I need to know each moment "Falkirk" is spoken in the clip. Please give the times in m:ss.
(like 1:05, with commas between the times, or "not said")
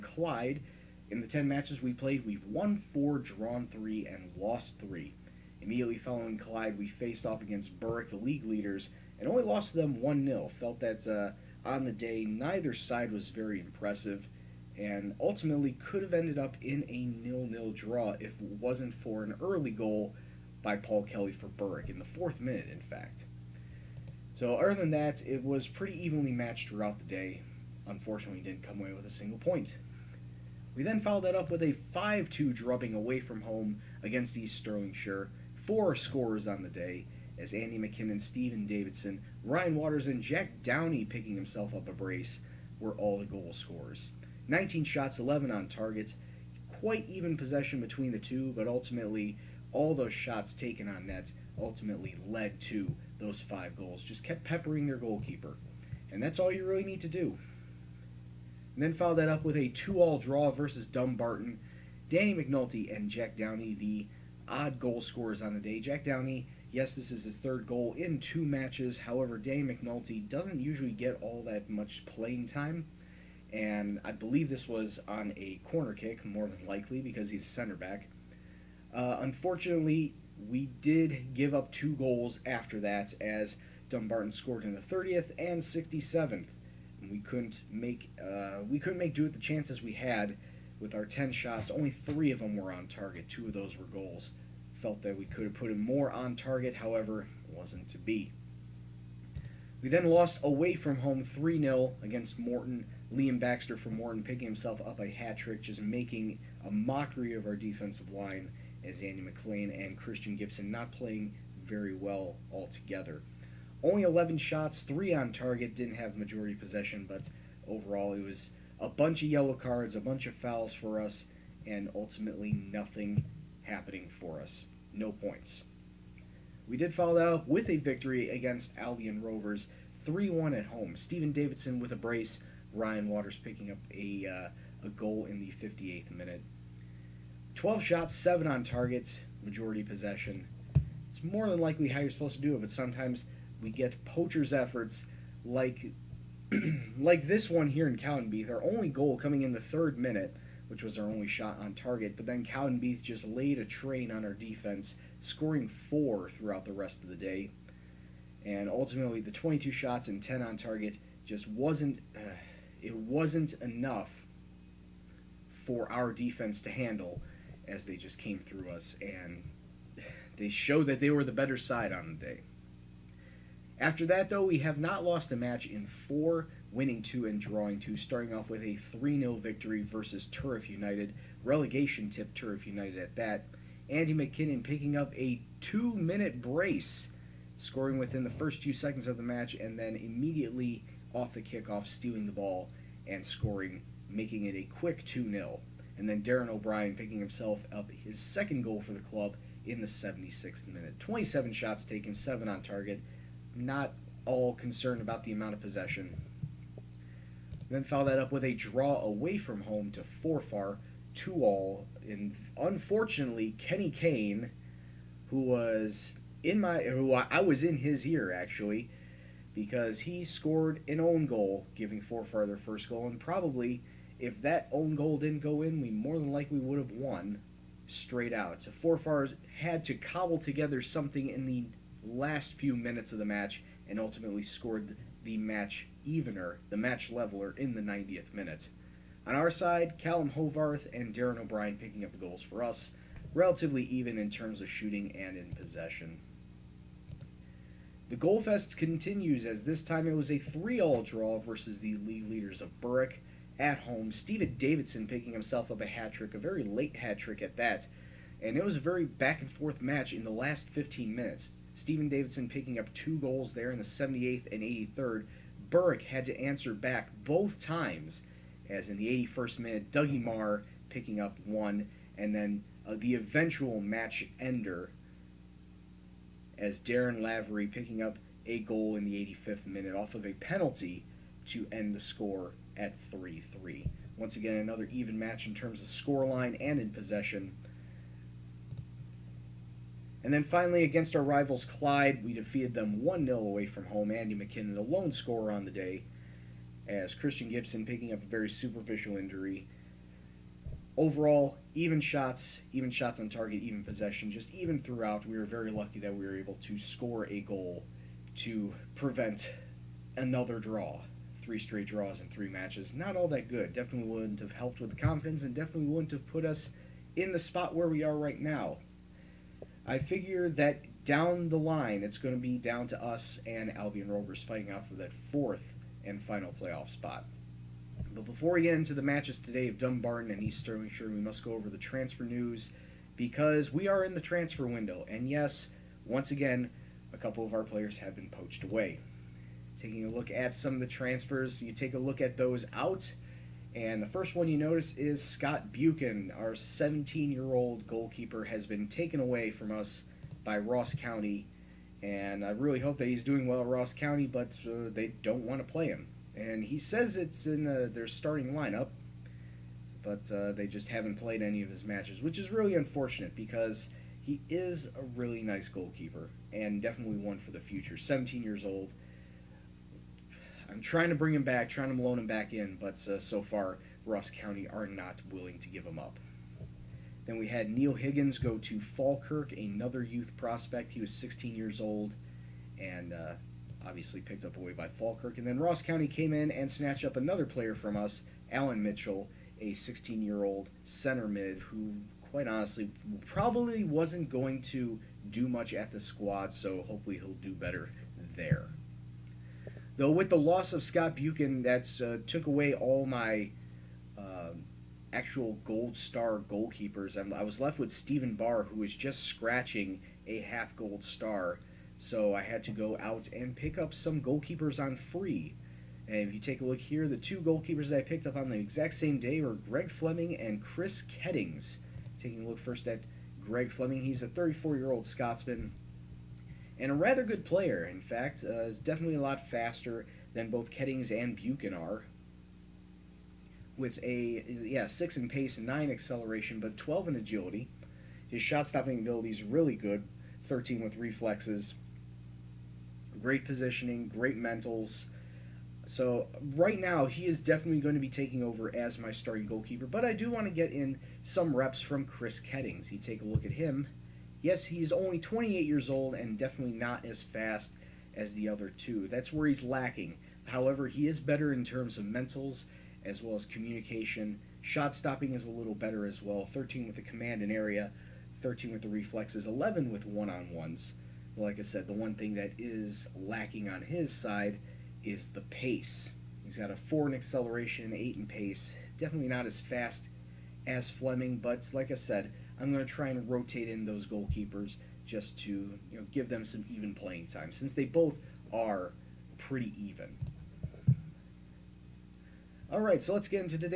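6:18, 6:24.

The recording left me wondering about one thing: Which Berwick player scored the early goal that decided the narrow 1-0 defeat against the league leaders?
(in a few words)
Paul Kelly.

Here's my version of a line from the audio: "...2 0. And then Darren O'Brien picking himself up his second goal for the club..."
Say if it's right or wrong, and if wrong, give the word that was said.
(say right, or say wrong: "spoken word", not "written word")
right.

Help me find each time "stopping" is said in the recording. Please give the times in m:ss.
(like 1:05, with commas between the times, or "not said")
7:18, 7:44.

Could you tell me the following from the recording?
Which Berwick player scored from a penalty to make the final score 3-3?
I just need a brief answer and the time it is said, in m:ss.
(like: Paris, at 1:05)
Darren Lavery, at 4:36.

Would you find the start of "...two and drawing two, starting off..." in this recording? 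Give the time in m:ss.
2:57.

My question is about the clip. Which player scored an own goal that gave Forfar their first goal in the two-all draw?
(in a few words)
Kenny Kane.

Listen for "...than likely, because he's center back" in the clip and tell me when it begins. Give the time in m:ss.
1:16.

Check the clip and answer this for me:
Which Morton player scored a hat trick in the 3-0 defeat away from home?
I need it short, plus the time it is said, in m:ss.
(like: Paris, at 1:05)
Liam Baxter, at 1:43.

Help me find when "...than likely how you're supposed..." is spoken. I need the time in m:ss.
2:21.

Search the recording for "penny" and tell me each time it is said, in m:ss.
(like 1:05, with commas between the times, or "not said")
not said.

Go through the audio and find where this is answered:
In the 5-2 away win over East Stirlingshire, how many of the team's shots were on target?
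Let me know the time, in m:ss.
0:45.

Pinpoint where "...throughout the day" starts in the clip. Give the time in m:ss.
0:26.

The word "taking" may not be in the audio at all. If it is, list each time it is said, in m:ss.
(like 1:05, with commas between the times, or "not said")
5:39, 7:02, 7:28.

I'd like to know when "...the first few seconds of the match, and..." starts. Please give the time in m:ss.
3:08.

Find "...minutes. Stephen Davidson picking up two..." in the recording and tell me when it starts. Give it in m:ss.
4:21.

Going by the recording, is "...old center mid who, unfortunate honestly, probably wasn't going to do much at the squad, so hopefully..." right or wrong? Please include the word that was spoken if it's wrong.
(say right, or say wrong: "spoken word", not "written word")
wrong: "quite", not "unfortunate".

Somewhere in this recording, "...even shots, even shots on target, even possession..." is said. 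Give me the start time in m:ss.
5:01.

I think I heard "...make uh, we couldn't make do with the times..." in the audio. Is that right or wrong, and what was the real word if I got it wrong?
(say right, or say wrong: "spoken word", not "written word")
wrong: "chances", not "times".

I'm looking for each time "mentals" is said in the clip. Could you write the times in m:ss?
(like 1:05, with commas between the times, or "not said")
7:24, 7:42.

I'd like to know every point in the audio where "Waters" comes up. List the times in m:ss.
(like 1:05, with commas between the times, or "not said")
0:39, 2:13.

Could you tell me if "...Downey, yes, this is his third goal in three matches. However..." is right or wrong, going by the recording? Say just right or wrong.
wrong.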